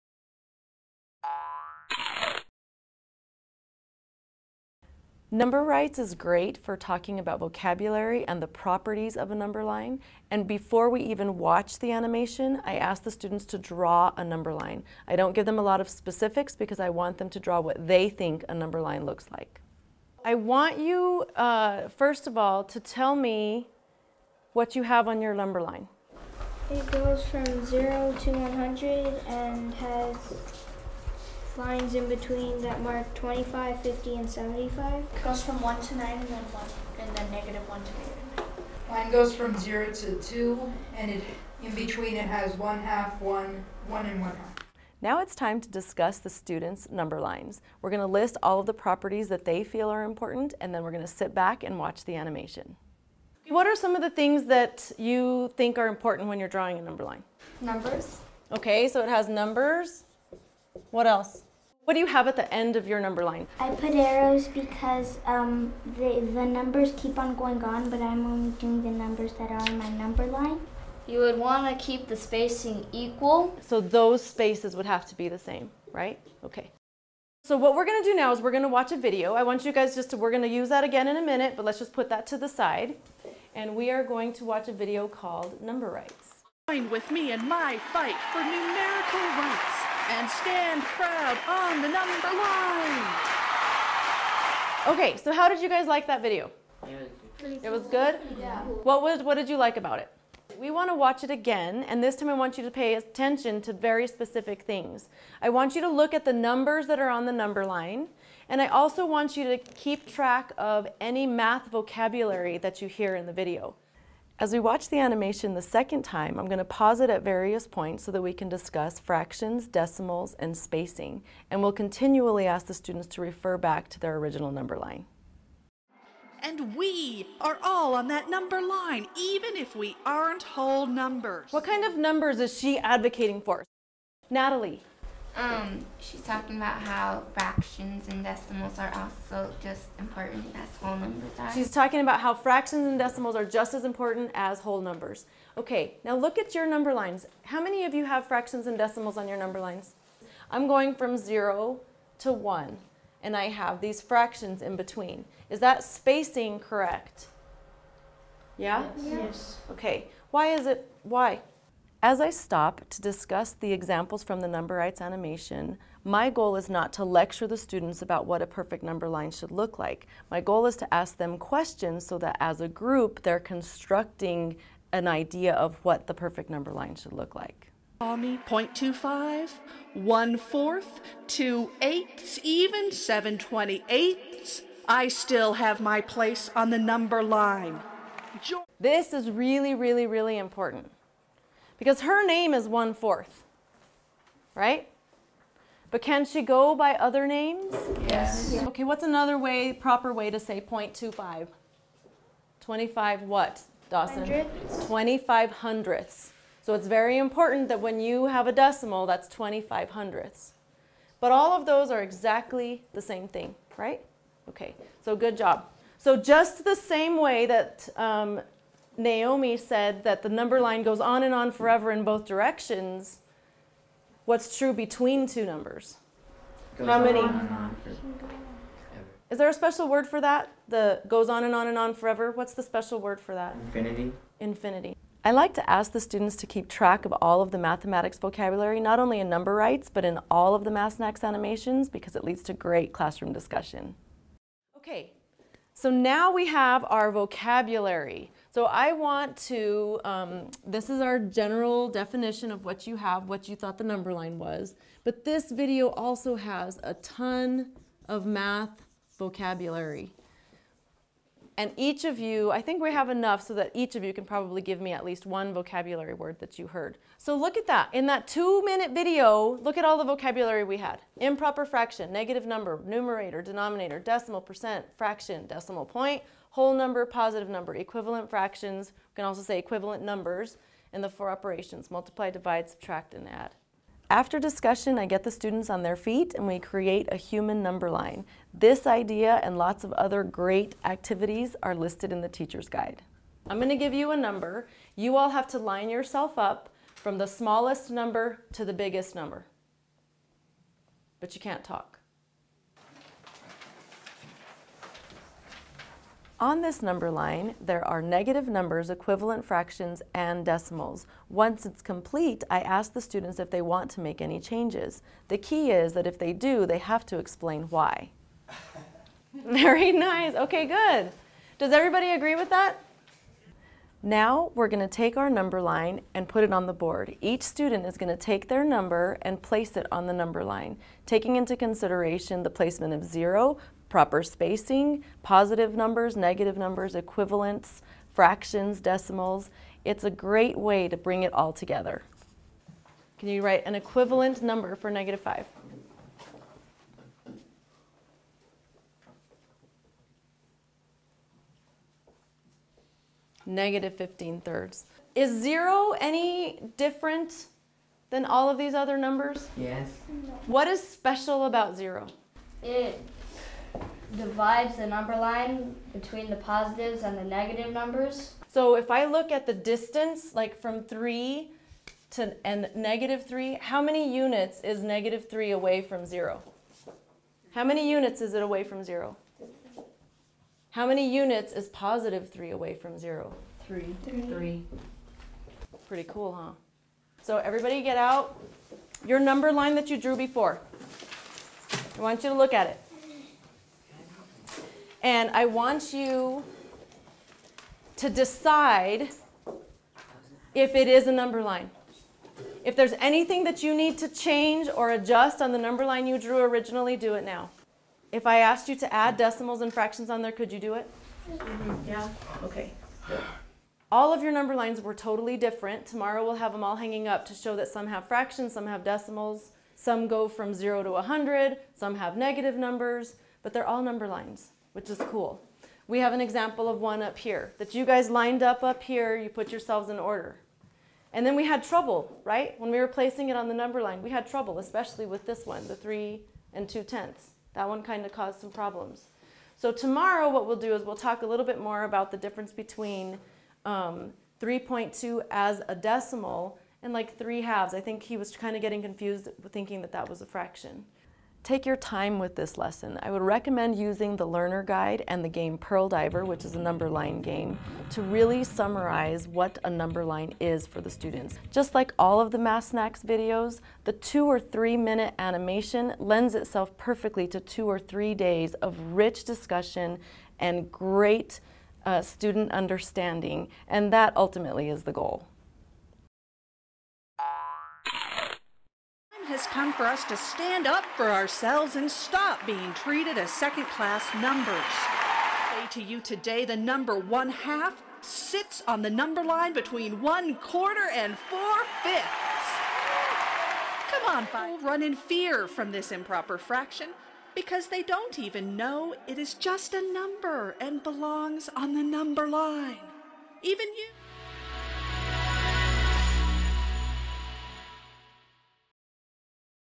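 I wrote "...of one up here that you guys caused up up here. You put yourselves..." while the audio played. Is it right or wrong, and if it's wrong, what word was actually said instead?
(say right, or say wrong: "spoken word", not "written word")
wrong: "lined", not "caused".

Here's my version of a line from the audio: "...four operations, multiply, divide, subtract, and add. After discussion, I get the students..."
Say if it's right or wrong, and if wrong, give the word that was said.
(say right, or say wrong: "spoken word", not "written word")
right.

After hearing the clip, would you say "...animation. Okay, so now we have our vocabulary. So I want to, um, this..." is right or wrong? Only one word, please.
wrong.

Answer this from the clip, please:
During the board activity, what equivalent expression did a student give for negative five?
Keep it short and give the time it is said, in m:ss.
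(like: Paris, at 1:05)
-15/3, at 5:53.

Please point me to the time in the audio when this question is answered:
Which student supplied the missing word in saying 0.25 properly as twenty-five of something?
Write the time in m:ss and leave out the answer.
3:23.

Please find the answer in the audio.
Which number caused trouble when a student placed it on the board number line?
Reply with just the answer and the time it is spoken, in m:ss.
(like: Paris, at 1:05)
3.2, at 7:15.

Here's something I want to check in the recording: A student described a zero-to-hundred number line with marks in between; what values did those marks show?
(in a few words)
25, 50, and 75.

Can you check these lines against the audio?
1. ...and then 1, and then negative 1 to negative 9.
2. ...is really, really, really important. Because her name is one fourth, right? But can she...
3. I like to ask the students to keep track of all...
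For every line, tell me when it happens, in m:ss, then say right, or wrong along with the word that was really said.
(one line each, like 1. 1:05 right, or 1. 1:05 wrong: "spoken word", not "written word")
1. 0:36 right
2. 3:09 right
3. 3:55 right.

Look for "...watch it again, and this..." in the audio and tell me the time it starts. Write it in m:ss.
1:40.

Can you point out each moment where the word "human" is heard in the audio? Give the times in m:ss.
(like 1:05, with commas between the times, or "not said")
4:47.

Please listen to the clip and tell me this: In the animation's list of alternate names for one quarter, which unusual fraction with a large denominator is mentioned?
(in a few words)
7/28.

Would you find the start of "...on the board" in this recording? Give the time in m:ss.
5:26.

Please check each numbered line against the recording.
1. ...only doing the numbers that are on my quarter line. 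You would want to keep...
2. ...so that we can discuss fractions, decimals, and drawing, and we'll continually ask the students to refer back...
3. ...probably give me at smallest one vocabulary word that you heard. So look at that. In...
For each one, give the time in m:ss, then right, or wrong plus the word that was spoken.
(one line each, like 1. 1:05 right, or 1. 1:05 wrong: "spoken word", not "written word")
1. 1:08 wrong: "number", not "quarter"
2. 1:58 wrong: "spacing", not "drawing"
3. 4:24 wrong: "least", not "smallest".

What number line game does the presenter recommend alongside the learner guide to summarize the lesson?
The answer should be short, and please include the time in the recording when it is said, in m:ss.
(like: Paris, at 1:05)
Pearl Diver, at 7:35.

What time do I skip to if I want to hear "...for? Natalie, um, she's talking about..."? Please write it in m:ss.
2:13.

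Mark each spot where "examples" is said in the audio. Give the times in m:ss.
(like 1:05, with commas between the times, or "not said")
2:43, 7:06.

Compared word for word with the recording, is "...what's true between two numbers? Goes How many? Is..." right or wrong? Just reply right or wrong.
right.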